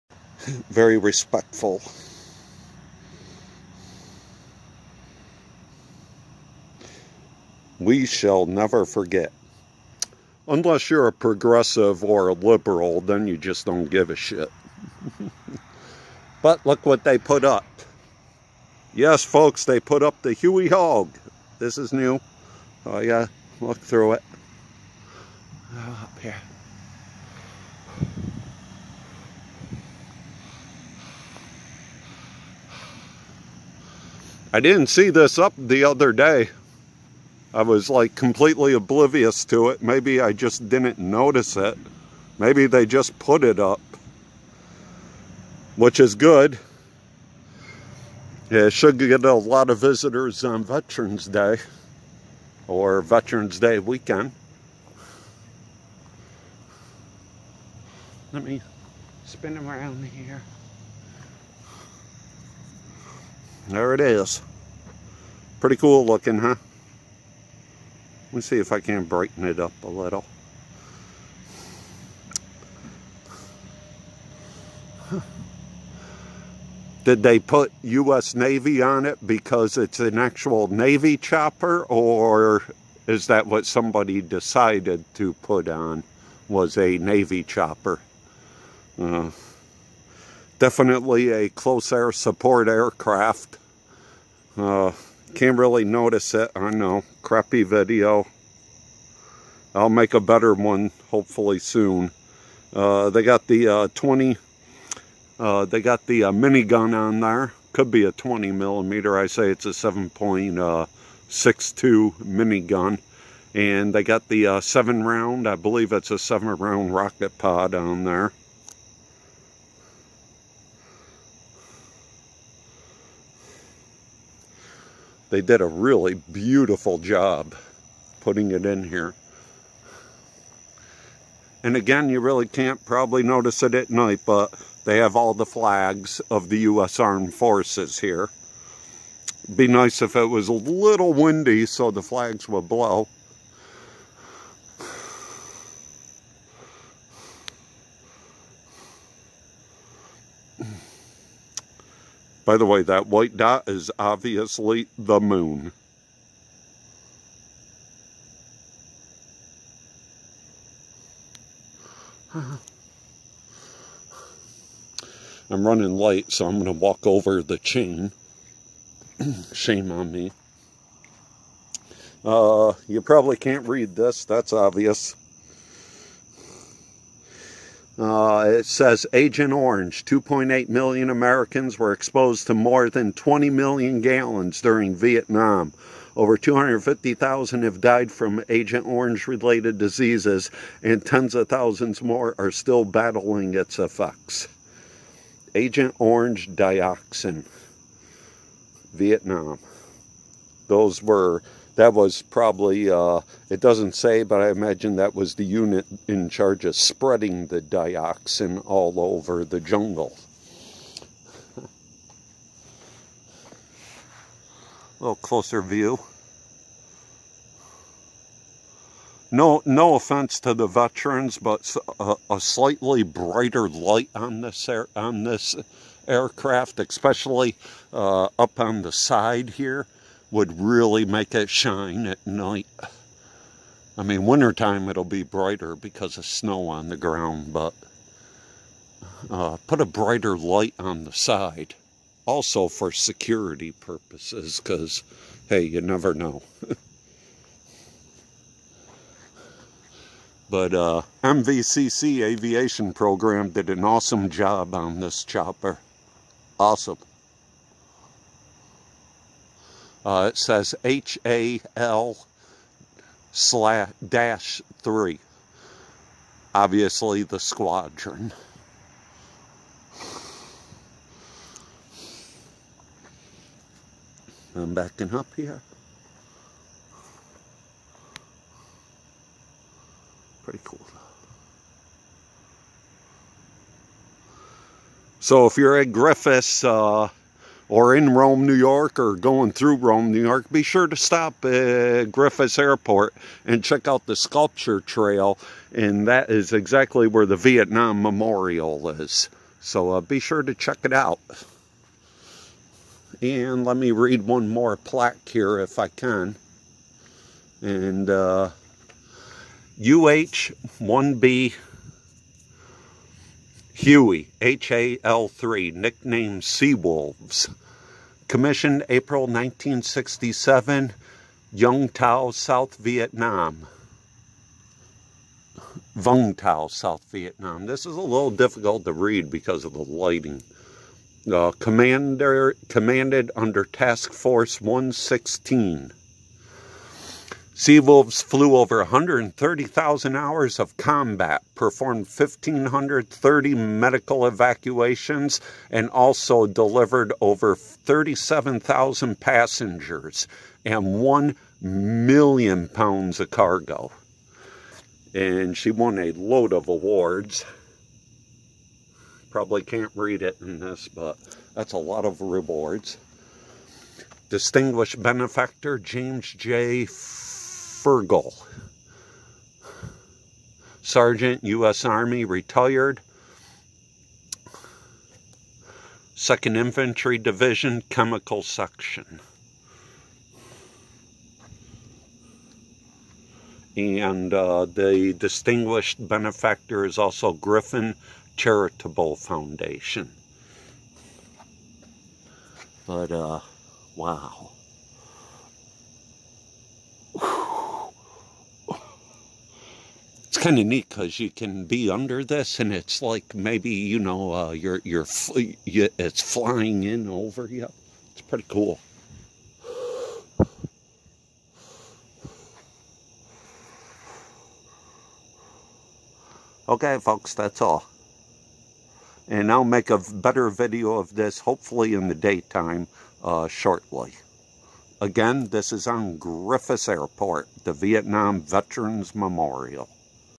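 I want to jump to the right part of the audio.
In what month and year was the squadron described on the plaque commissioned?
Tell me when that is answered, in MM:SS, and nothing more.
05:18.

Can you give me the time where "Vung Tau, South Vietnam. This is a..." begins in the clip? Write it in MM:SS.
05:25.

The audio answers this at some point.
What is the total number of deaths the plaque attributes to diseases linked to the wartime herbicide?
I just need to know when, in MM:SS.
03:06.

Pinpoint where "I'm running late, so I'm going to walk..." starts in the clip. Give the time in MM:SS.
02:45.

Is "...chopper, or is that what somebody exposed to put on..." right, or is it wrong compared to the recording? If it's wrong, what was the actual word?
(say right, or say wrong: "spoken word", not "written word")
wrong: "decided", not "exposed".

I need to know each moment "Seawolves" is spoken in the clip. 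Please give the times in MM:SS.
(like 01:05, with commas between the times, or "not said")
05:16, 05:37.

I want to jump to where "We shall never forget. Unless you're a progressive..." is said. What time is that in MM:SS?
00:07.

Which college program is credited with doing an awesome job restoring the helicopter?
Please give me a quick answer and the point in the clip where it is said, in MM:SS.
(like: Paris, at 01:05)
MVCC Aviation Program, at 04:11.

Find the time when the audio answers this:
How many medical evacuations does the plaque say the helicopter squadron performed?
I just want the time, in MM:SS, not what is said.
05:42.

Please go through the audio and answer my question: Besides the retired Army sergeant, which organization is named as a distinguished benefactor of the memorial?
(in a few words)
Griffin Charitable Foundation.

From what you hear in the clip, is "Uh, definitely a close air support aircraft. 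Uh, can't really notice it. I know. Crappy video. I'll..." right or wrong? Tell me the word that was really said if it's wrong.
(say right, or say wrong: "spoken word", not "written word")
right.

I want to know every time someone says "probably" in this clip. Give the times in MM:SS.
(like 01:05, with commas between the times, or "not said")
02:12, 02:53, 03:22, 05:59.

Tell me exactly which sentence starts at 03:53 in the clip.
I mean, wintertime it'll be brighter because of snow on the ground, but uh, put a brighter light on the side.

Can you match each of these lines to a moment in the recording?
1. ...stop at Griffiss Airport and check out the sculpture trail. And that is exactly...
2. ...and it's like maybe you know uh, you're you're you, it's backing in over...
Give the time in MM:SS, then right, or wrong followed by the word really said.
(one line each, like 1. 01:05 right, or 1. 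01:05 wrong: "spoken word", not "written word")
1. 04:50 right
2. 06:42 wrong: "flying", not "backing".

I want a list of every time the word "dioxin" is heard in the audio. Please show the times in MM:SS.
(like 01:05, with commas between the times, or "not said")
03:16, 03:27.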